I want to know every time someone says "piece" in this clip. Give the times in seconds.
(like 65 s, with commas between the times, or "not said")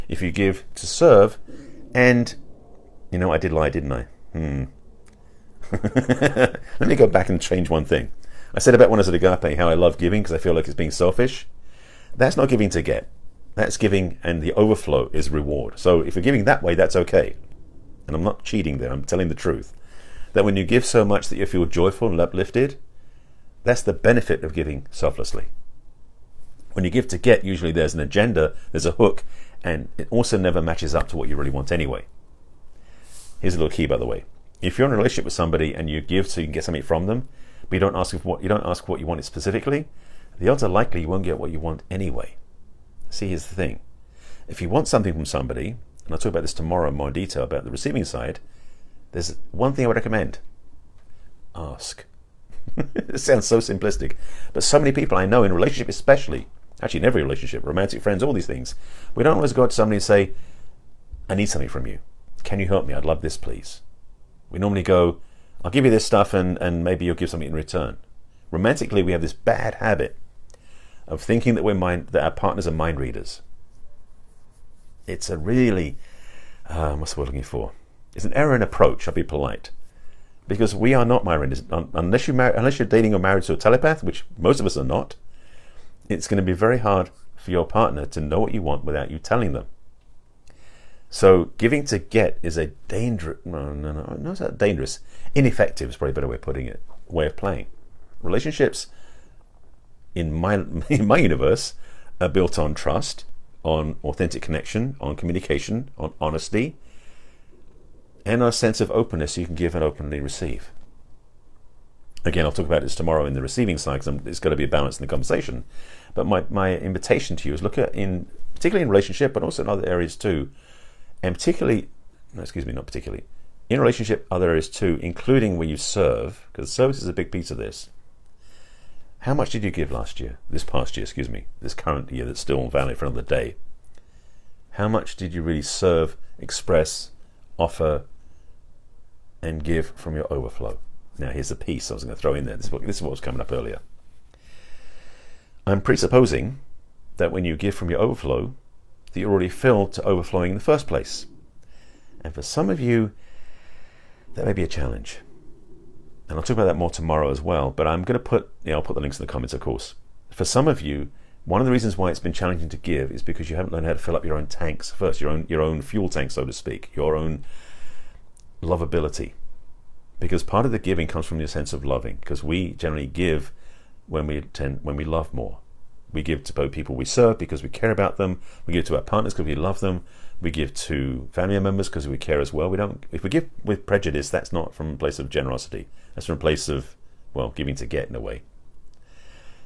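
127 s, 141 s.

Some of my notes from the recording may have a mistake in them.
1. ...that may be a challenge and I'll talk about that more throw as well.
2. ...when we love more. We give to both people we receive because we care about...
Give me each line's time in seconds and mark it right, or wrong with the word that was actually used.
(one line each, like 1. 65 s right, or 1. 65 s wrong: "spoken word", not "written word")
1. 154 s wrong: "tomorrow", not "throw"
2. 174 s wrong: "serve", not "receive".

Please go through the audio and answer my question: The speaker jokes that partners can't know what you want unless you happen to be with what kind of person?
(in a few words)
A telepath.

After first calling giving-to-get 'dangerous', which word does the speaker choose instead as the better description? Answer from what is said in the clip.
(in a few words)
Ineffective.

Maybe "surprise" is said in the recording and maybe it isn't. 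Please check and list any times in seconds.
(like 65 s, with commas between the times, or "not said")
not said.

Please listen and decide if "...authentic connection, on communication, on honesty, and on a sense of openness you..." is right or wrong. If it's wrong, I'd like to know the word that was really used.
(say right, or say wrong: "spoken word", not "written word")
right.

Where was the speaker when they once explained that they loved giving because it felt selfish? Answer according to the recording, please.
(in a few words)
Agape.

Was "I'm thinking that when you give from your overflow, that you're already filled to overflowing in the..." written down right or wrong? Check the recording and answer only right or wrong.
wrong.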